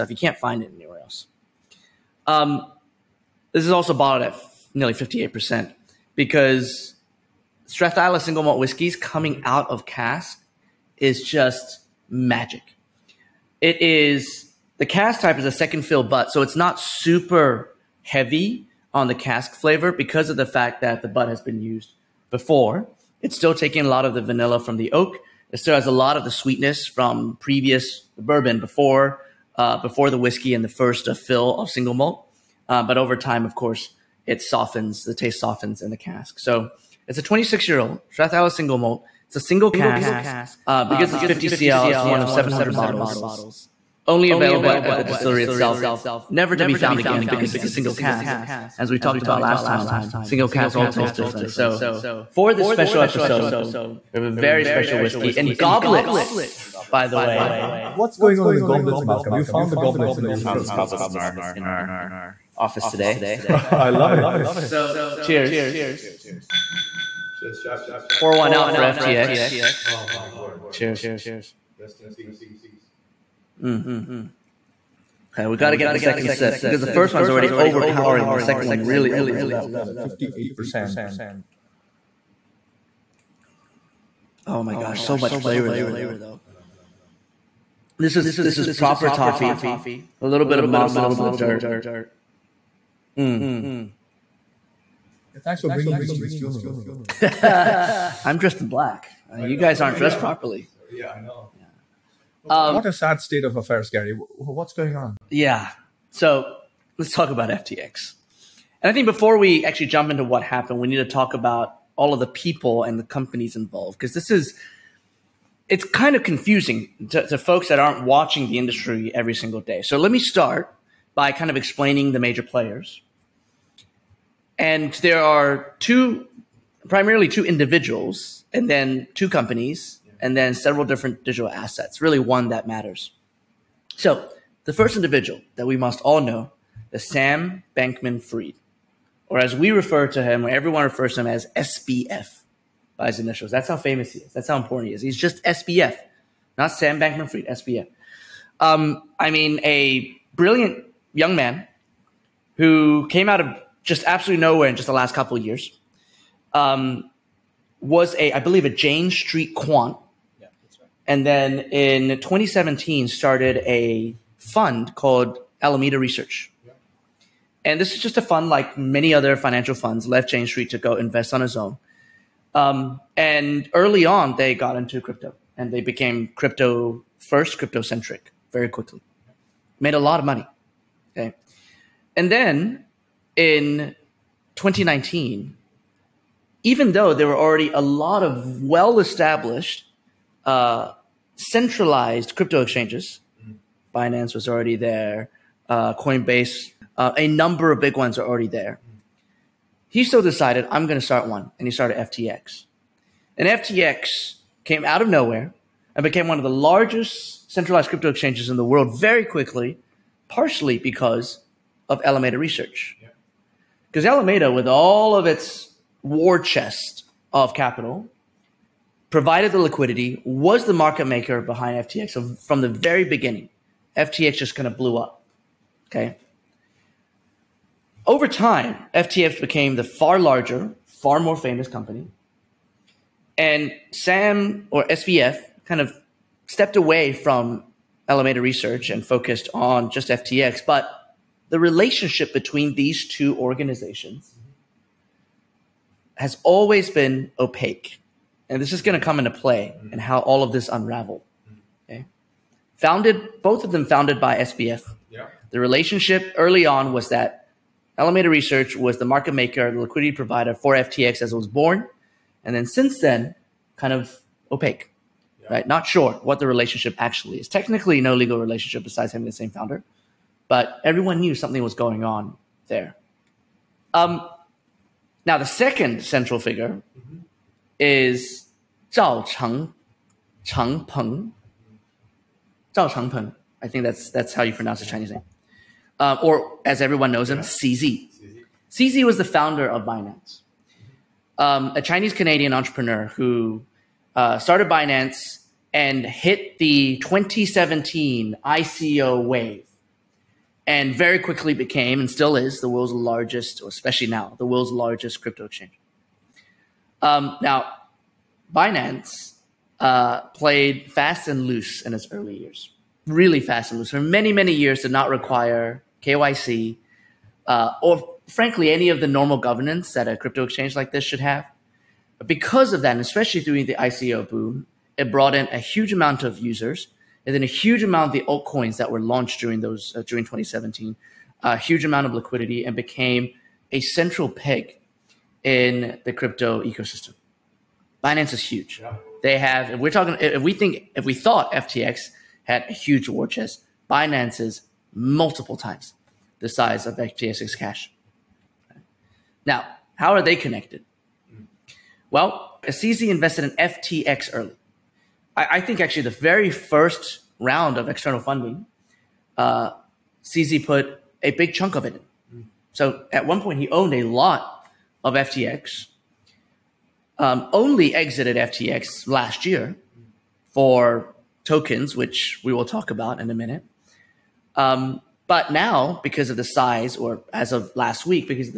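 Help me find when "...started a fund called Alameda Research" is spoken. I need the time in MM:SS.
02:43.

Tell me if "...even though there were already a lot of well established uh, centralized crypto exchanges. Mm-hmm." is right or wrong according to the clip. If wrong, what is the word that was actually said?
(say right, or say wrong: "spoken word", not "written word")
right.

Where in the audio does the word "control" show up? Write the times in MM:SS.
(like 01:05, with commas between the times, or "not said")
not said.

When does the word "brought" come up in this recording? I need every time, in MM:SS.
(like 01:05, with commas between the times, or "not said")
05:25.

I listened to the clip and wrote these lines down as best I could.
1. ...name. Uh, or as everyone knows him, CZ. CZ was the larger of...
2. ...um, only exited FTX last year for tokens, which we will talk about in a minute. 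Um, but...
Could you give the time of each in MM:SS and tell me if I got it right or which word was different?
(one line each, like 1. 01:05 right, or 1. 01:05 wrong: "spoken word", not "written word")
1. 04:45 wrong: "founder", not "larger"
2. 06:07 right.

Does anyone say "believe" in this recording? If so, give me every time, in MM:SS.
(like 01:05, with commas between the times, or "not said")
02:38.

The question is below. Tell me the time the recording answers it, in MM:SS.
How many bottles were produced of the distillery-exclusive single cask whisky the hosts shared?
00:42.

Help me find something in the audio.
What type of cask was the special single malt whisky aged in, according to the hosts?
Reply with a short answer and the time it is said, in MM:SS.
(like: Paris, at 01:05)
Second fill butt, at 00:15.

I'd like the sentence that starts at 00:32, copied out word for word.
Uh, but over time, of course, it softens.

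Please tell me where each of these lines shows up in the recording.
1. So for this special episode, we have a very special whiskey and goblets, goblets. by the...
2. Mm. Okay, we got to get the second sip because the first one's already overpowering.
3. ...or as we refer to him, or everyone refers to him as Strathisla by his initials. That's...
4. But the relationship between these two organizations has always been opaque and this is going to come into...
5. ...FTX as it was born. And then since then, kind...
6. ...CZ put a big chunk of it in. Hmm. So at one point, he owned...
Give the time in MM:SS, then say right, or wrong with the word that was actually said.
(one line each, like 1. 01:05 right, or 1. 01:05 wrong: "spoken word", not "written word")
1. 00:51 right
2. 01:13 right
3. 02:19 wrong: "SBF", not "Strathisla"
4. 04:00 right
5. 04:20 right
6. 06:00 right.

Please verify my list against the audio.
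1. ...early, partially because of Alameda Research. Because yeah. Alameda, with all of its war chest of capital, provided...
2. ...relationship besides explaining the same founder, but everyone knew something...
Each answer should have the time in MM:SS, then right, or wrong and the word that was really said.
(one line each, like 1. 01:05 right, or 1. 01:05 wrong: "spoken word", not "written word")
1. 03:29 wrong: "quickly", not "early"
2. 04:28 wrong: "having", not "explaining".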